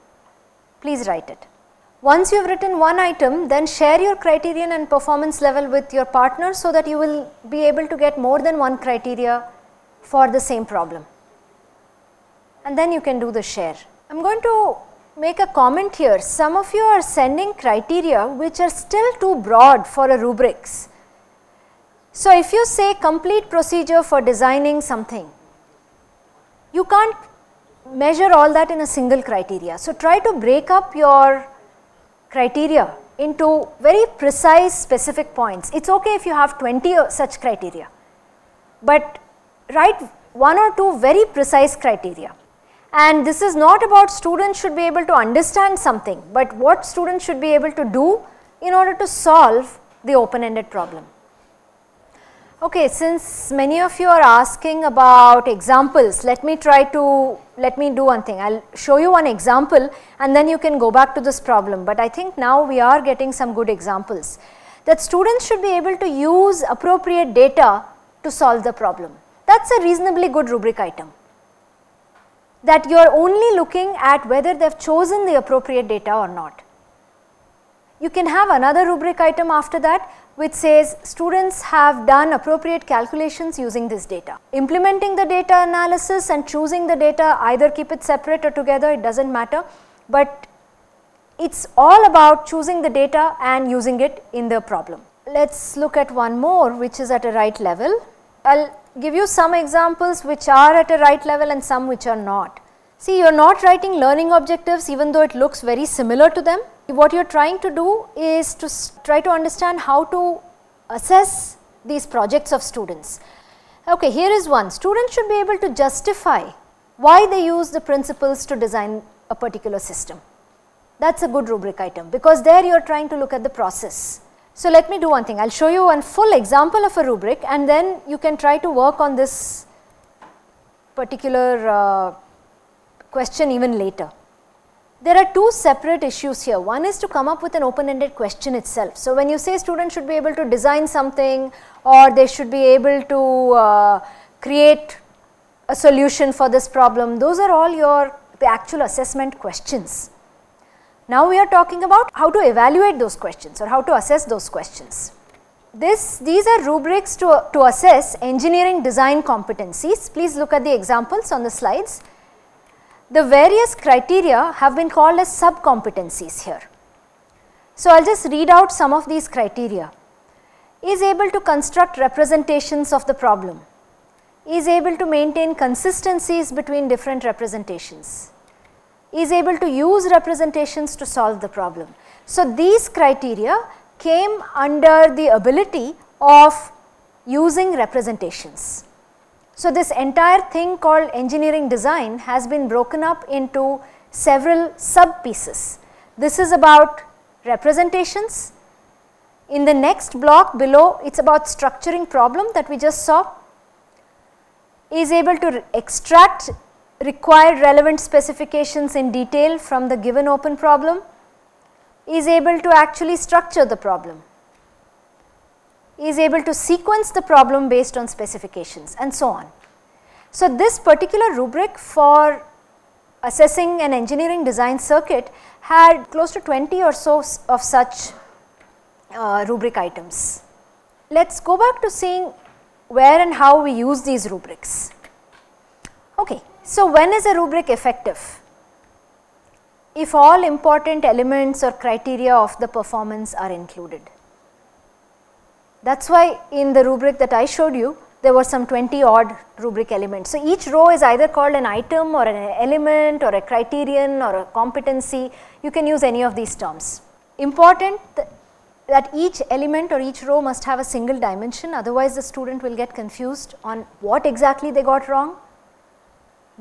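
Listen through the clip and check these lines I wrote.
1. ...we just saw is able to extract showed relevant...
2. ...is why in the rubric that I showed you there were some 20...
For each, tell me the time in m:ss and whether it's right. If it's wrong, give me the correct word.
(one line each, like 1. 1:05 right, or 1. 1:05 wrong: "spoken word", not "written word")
1. 3:22 wrong: "required", not "showed"
2. 4:06 right.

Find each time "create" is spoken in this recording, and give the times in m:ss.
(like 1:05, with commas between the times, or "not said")
2:24.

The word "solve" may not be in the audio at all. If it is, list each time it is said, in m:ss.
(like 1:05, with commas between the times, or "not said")
0:49, 1:08, 3:01.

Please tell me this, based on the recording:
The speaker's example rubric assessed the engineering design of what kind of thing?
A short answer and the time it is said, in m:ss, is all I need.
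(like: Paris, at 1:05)
circuit, at 3:44.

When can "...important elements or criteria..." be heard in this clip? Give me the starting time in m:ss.
4:00.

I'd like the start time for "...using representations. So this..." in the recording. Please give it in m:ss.
3:07.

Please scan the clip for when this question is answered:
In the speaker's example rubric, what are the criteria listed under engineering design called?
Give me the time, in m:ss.
2:45.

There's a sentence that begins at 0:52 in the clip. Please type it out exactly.
Okay, since many of you are asking about examples, let me try to, let me do one thing.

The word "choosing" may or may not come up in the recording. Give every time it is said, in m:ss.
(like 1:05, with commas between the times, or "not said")
1:26, 1:32.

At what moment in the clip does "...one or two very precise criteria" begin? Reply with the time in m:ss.
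0:40.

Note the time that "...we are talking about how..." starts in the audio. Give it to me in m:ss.
2:31.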